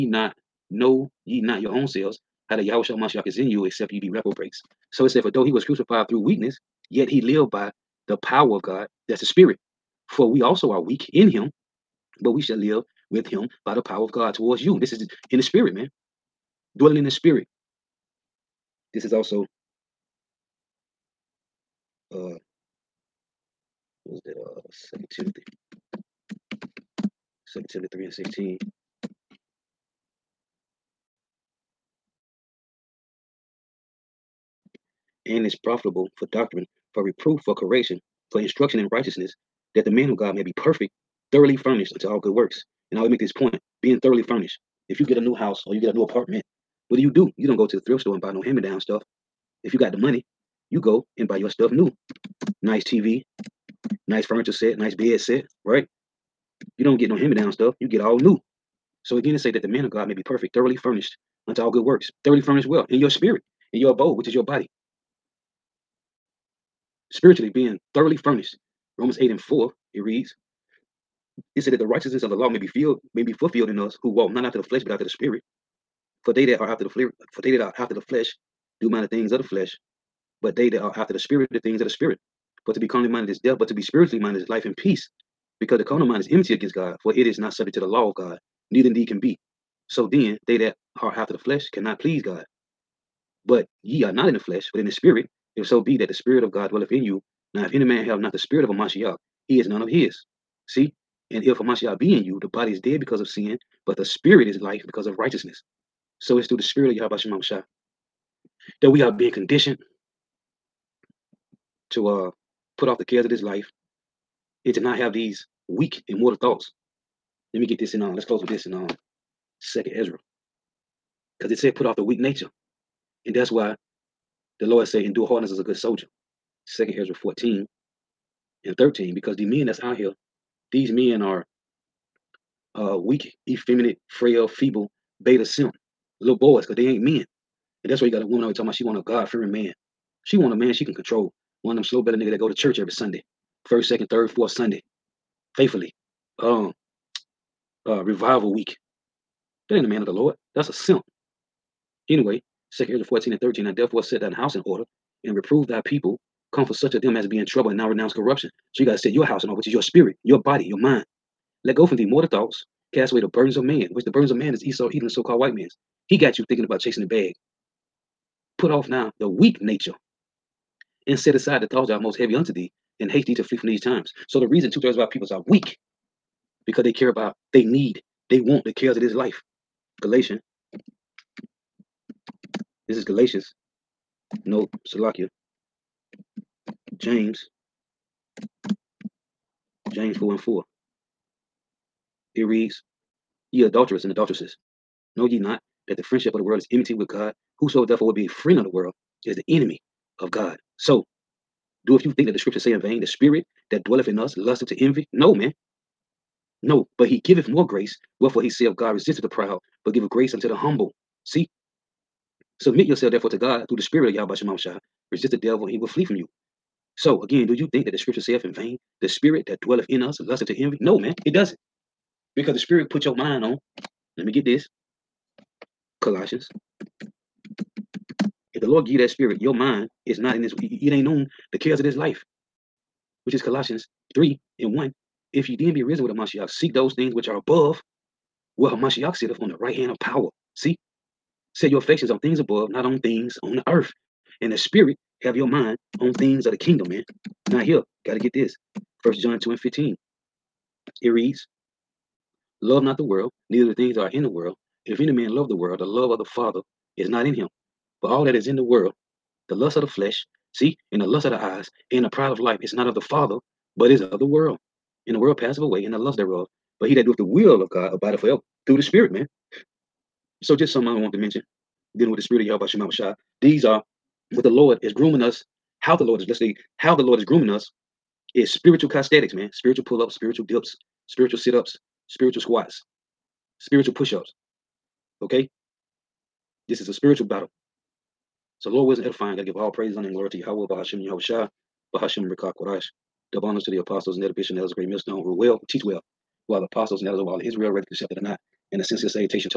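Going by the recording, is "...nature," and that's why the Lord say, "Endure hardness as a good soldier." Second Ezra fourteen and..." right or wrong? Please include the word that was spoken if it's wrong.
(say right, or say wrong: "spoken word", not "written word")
right.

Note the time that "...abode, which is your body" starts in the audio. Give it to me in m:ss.
1:03.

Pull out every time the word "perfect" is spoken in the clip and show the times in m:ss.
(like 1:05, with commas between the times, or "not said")
0:40, 1:00.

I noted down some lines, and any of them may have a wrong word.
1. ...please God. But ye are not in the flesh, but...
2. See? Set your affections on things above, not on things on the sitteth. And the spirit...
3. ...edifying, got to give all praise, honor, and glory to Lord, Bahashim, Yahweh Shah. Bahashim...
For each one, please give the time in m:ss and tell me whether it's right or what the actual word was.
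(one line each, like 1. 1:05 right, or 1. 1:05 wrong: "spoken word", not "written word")
1. 1:31 right
2. 4:00 wrong: "earth", not "sitteth"
3. 4:49 wrong: "Yahweh", not "Lord".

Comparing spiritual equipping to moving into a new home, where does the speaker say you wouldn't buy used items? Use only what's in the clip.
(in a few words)
thrift store.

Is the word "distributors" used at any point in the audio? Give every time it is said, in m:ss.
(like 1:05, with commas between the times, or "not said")
not said.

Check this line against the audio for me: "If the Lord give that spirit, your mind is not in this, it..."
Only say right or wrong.
right.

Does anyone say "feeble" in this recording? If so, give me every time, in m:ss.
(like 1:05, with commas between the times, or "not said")
2:14.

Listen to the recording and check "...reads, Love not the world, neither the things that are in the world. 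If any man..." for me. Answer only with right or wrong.
right.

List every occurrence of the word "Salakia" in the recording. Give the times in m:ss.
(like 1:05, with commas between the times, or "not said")
3:04.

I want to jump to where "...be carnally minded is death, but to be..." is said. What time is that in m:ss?
1:22.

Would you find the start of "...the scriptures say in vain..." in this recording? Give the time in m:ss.
3:22.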